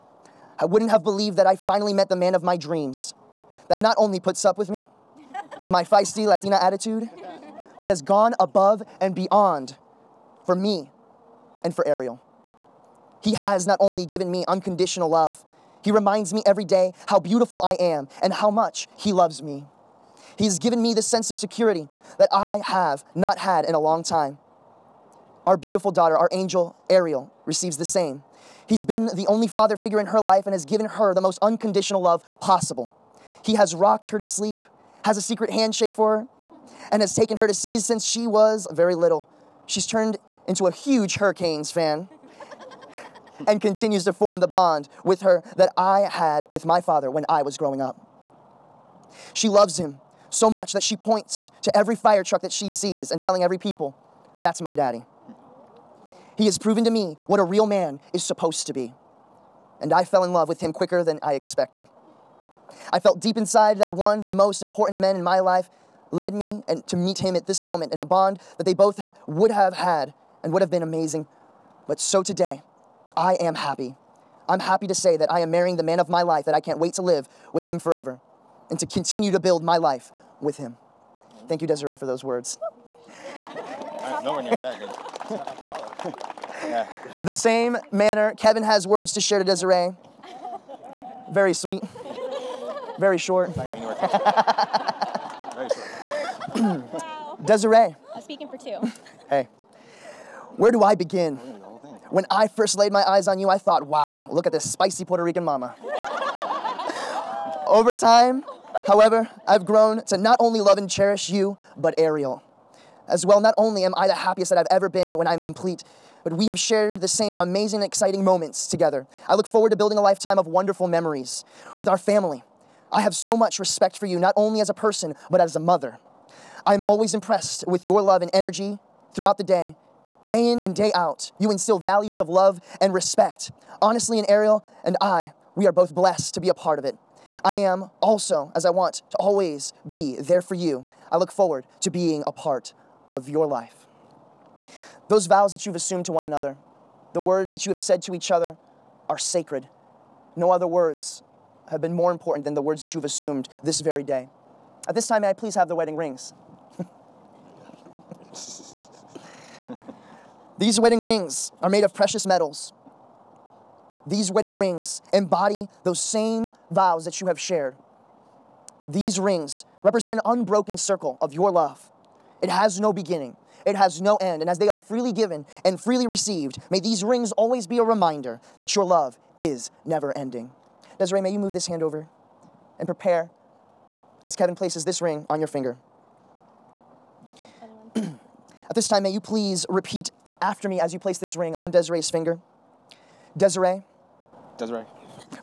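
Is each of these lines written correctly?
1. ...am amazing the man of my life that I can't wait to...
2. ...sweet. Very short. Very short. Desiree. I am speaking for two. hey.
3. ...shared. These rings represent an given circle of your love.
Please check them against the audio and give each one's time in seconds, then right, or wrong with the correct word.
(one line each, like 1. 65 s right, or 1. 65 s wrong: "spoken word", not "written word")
1. 75 s wrong: "marrying", not "amazing"
2. 91 s right
3. 167 s wrong: "unbroken", not "given".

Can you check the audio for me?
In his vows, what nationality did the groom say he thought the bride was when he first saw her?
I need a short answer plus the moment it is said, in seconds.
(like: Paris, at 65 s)
Puerto Rican, at 105 s.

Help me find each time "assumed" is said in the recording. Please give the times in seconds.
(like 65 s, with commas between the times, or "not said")
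145 s, 153 s.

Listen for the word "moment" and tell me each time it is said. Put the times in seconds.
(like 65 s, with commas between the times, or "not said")
67 s, 118 s.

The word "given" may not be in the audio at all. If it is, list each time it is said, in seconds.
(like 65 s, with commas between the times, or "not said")
14 s, 20 s, 30 s, 175 s.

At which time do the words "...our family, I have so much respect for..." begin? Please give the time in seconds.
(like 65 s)
121 s.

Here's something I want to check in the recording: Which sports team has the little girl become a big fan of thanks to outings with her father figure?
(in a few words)
Hurricanes.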